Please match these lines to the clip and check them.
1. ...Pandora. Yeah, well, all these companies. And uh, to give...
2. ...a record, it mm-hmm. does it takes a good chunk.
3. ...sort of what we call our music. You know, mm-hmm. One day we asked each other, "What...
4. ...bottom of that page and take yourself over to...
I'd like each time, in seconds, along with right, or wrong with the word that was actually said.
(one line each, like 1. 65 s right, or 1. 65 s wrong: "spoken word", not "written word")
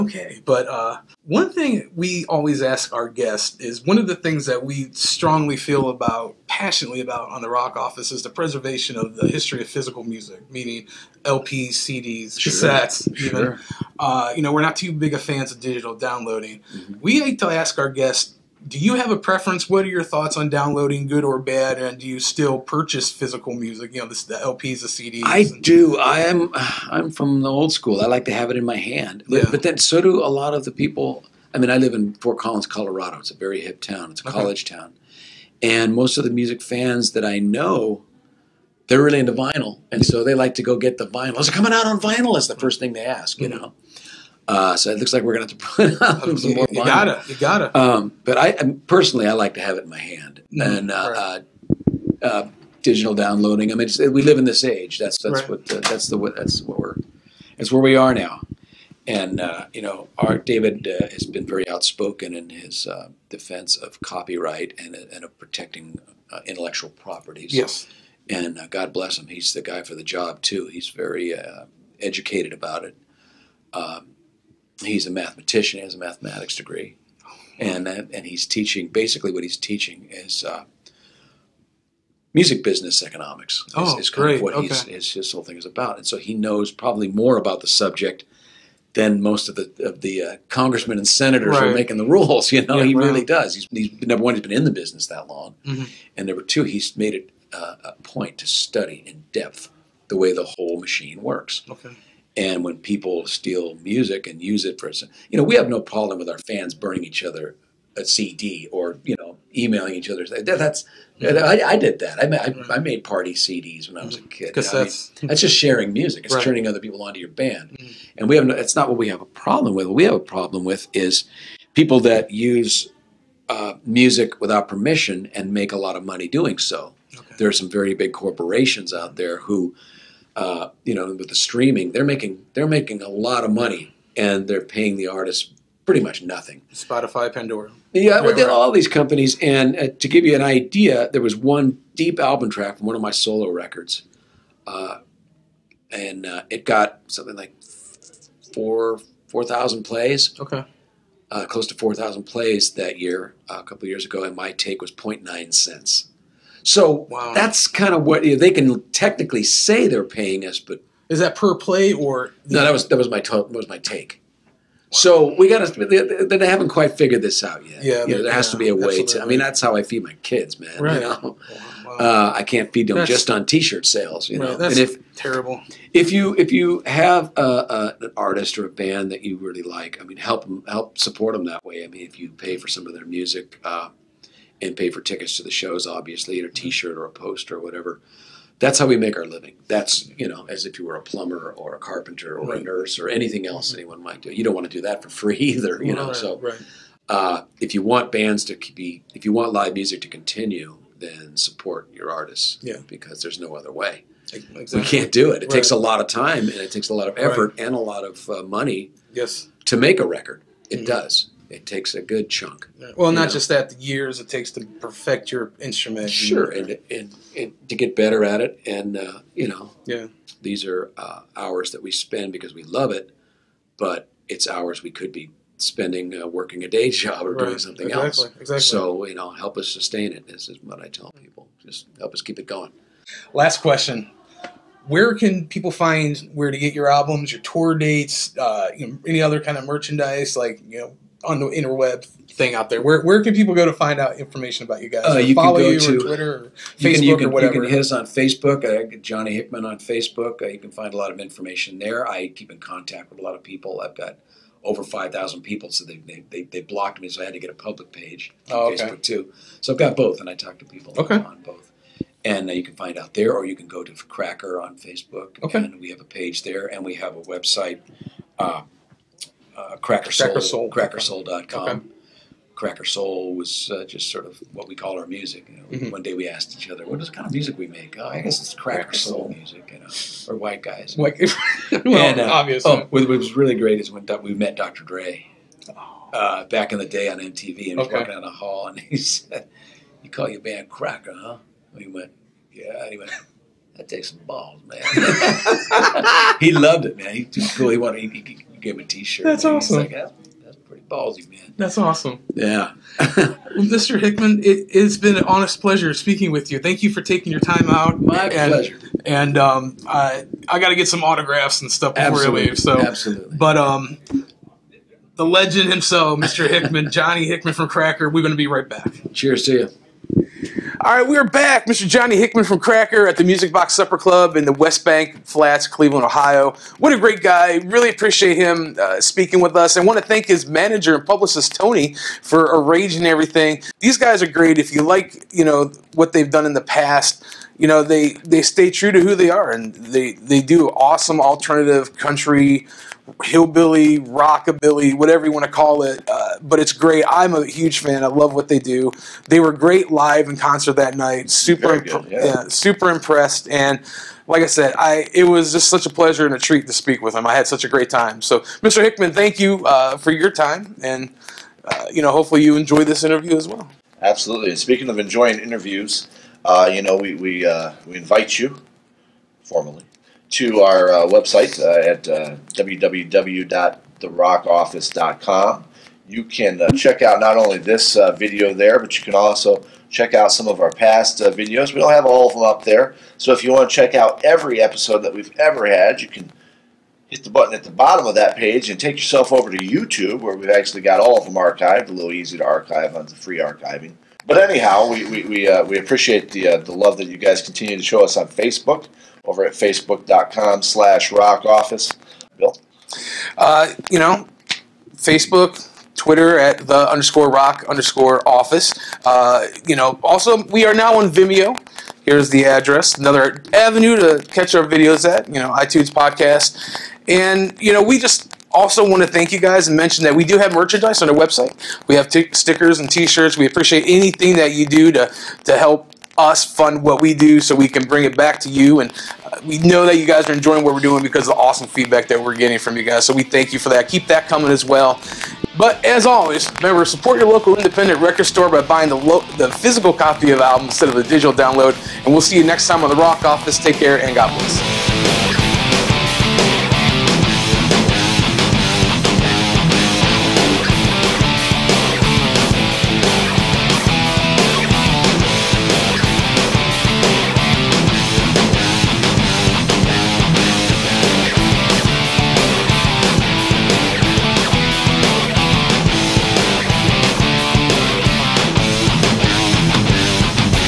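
1. 137 s right
2. 210 s right
3. 274 s right
4. 387 s right.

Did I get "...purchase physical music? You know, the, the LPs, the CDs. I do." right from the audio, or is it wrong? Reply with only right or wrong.
right.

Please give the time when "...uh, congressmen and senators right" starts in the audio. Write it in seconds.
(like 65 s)
90 s.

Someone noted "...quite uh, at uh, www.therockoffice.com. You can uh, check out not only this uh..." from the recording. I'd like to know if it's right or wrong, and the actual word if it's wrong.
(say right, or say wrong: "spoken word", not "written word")
wrong: "website", not "quite".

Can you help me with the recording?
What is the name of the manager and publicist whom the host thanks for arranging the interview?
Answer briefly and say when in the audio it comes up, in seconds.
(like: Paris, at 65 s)
Tony, at 331 s.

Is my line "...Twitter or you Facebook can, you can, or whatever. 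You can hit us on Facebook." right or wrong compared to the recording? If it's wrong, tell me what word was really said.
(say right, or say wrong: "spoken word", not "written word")
right.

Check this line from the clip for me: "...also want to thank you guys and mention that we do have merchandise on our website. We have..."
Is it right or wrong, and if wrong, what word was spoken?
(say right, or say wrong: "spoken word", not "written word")
right.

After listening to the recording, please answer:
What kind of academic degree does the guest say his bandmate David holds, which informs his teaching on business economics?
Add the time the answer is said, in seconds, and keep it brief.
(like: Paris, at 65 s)
Mathematics degree, at 75 s.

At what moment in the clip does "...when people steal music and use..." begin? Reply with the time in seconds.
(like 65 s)
102 s.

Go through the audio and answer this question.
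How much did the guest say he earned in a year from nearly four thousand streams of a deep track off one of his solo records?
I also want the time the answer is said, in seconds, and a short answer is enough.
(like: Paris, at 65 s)
0.9 cents, at 154 s.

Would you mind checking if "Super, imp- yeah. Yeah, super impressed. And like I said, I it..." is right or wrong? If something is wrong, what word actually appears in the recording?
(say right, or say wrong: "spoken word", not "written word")
right.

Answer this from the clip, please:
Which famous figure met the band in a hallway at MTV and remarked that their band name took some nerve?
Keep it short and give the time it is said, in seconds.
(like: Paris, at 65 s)
Dr. Dre, at 284 s.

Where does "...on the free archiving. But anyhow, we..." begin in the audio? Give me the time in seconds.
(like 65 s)
392 s.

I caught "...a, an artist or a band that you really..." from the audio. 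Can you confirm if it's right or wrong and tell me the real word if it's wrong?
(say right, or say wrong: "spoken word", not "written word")
right.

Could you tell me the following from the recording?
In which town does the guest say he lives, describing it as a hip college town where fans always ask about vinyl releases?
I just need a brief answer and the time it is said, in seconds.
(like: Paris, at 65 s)
Fort Collins, at 32 s.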